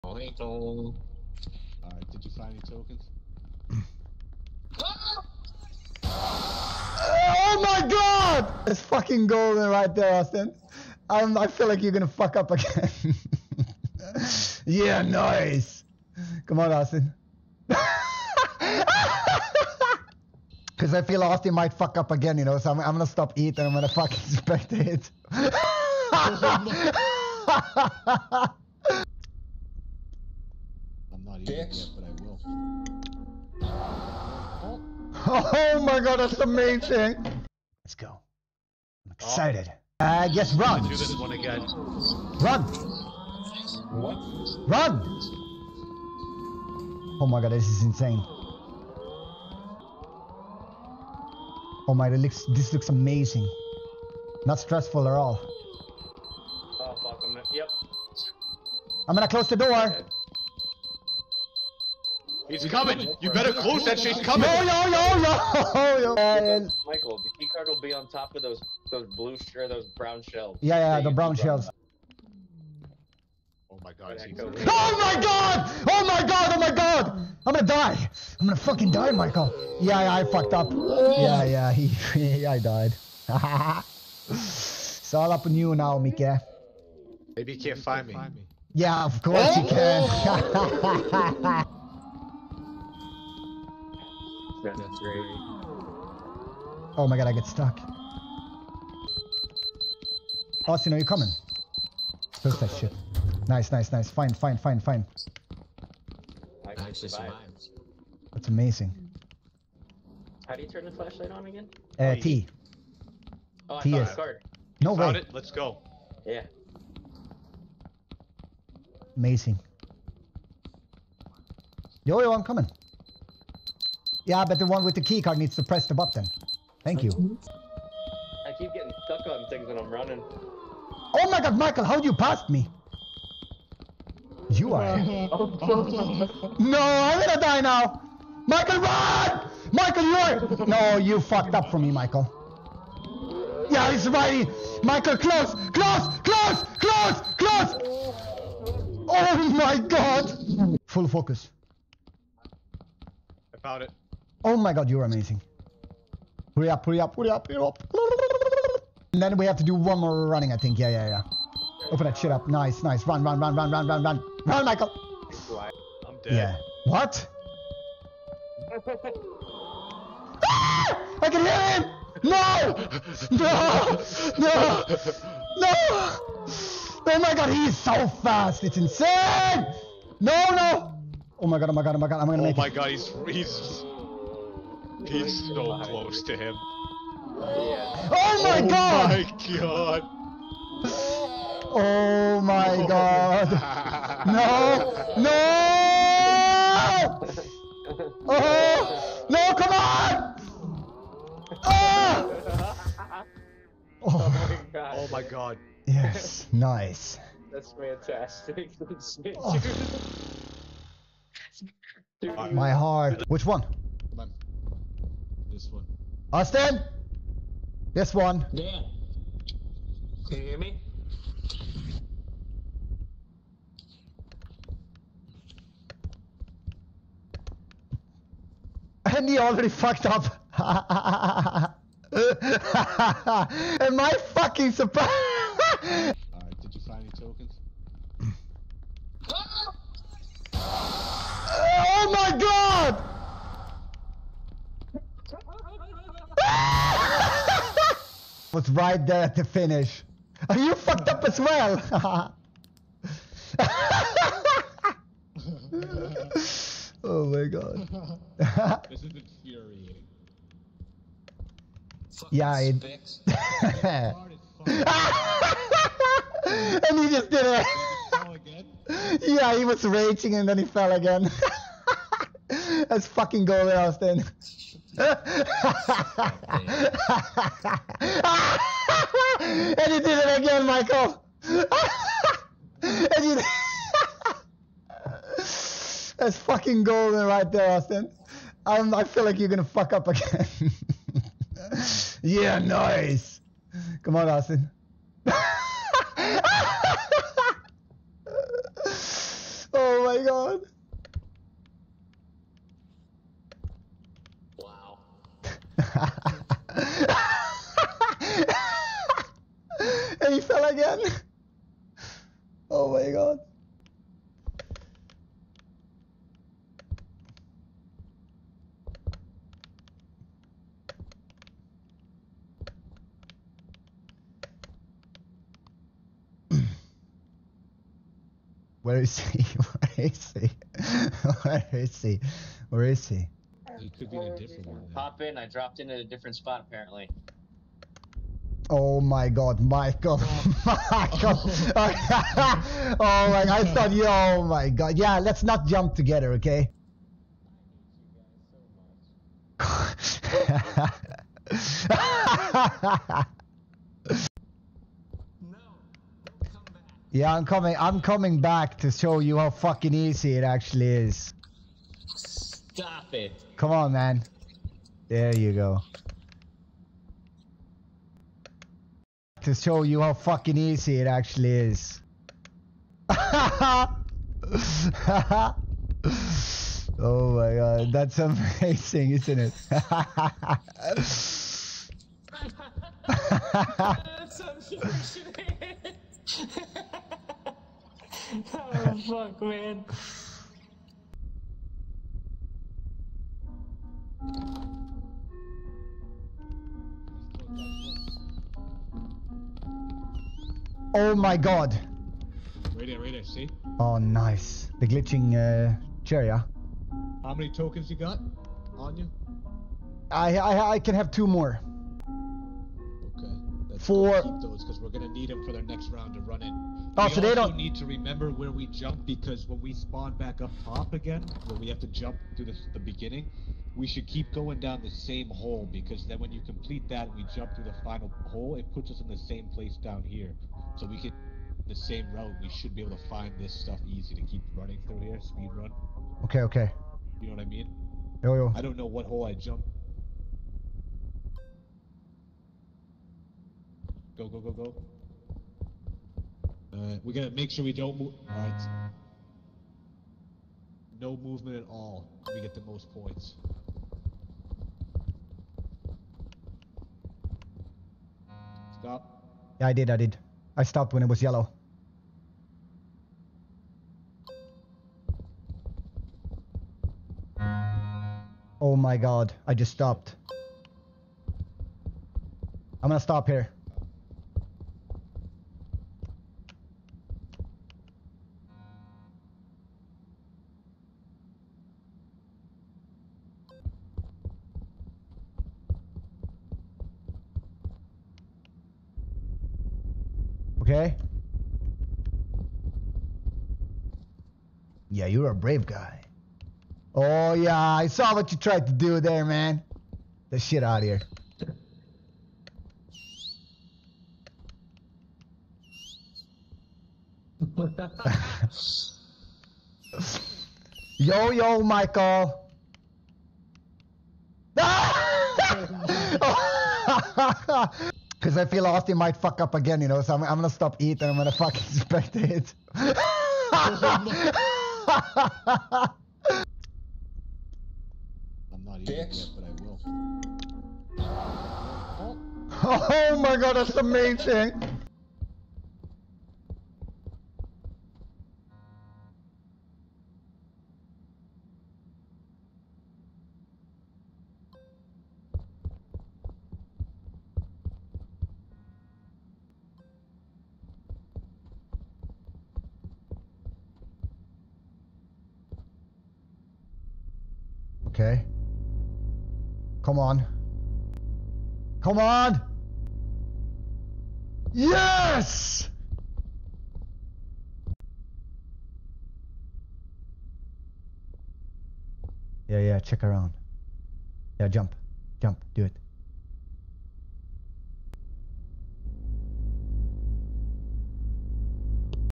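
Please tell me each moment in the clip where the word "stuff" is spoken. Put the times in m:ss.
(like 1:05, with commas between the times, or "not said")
7:13.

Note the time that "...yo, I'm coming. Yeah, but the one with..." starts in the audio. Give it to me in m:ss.
2:02.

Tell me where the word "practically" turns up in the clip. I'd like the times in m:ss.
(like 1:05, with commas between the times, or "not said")
not said.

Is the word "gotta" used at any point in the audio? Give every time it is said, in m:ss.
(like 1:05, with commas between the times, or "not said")
7:27.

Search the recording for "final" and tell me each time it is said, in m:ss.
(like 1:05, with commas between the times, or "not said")
7:07.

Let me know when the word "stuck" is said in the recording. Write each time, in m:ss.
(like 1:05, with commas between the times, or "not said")
1:37, 2:09.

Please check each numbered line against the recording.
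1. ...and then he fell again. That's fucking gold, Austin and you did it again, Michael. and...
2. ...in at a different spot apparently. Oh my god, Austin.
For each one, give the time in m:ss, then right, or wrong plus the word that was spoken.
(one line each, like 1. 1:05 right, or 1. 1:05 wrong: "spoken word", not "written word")
1. 4:30 right
2. 5:35 wrong: "Michael", not "Austin".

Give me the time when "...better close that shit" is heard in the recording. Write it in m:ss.
1:03.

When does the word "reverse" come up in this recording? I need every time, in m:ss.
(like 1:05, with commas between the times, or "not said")
not said.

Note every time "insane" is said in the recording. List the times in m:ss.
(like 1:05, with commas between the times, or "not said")
0:47, 2:58.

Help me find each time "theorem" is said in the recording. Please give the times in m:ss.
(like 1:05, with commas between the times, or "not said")
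not said.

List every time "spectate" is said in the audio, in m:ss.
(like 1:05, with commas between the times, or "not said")
0:24, 8:42.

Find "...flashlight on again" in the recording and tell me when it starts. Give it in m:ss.
1:50.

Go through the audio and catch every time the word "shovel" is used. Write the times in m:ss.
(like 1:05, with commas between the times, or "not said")
not said.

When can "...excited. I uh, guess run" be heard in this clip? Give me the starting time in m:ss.
0:39.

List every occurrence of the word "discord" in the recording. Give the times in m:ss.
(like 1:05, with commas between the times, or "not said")
not said.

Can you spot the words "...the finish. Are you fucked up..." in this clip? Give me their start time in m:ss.
4:09.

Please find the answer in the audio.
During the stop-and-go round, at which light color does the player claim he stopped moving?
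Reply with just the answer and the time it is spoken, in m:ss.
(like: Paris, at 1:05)
yellow, at 7:40.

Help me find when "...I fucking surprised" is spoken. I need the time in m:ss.
3:53.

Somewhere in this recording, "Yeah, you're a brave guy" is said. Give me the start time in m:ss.
8:14.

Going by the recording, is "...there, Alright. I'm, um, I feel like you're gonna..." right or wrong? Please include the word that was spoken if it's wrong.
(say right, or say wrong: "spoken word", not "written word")
wrong: "Austin", not "Alright".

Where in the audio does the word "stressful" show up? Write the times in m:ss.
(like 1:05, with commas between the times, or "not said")
0:54.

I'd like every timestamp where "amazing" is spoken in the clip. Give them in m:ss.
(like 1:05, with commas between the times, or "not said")
0:36, 0:52, 1:48, 1:59, 2:35, 6:18, 8:53.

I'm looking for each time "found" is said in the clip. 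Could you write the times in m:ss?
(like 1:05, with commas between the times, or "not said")
2:33.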